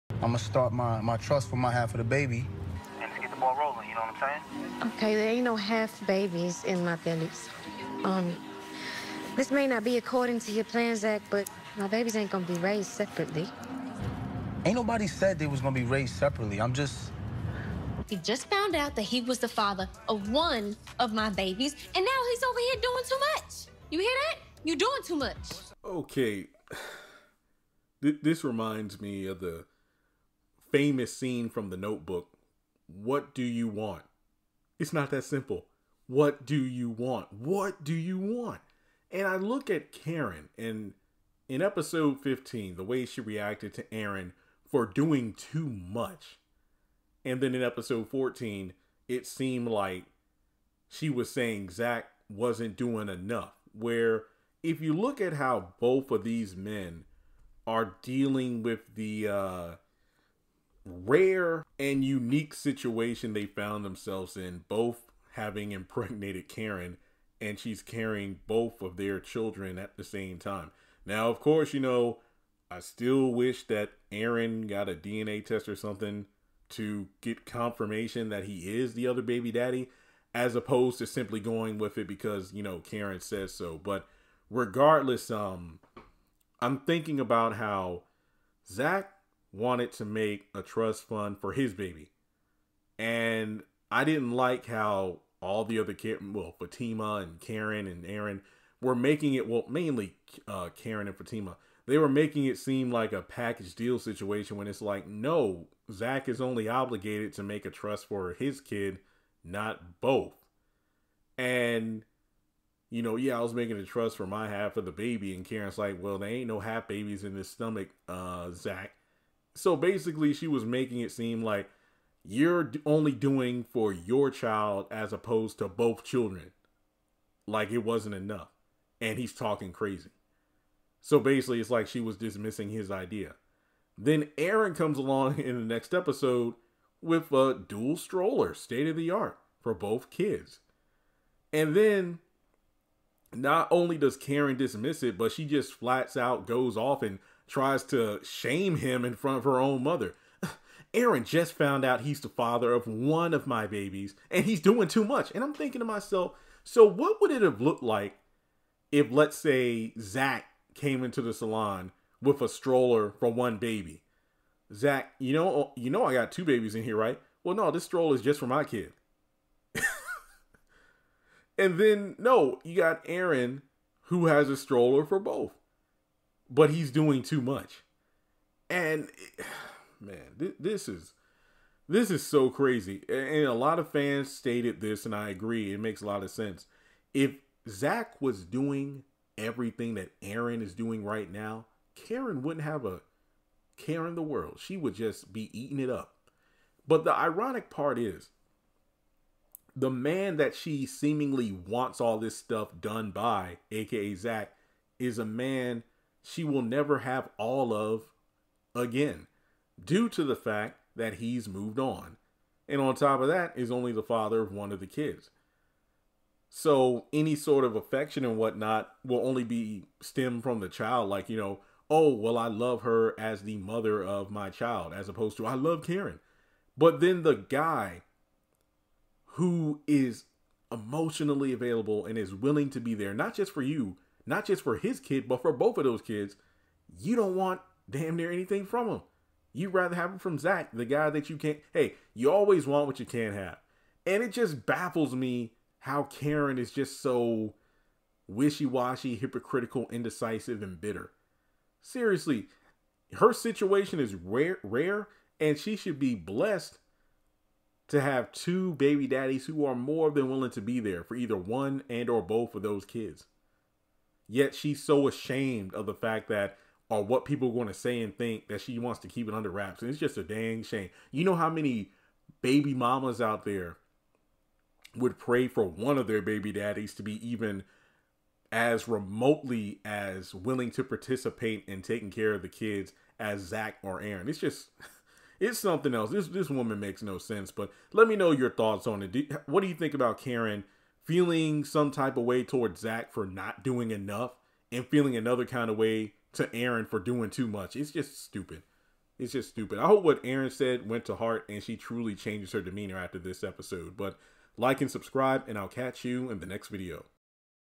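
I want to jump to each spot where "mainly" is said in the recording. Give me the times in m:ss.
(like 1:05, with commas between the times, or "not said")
1:39.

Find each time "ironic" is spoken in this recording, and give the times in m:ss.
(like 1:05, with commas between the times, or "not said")
3:17.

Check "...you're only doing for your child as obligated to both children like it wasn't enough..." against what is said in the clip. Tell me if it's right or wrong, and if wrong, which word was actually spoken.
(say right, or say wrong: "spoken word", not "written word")
wrong: "opposed", not "obligated".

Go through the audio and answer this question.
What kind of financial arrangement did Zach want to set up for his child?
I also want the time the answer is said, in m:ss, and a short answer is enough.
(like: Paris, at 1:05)
Trust fund, at 1:30.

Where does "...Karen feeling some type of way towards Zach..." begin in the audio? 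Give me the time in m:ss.
4:50.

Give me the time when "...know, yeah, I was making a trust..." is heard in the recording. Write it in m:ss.
1:53.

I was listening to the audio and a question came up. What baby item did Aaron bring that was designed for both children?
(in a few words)
Dual stroller.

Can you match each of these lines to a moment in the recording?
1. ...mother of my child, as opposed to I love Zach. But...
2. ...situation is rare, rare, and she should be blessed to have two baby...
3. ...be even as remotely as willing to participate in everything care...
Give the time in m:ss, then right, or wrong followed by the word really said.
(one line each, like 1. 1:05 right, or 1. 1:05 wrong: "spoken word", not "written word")
1. 3:43 wrong: "Karen", not "Zach"
2. 4:13 right
3. 4:37 wrong: "taking", not "everything".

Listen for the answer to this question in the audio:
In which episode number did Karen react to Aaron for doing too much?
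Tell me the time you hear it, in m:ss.
0:41.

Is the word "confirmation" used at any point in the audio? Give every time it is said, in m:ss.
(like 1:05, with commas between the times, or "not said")
1:17.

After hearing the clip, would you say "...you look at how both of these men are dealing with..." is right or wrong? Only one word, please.
right.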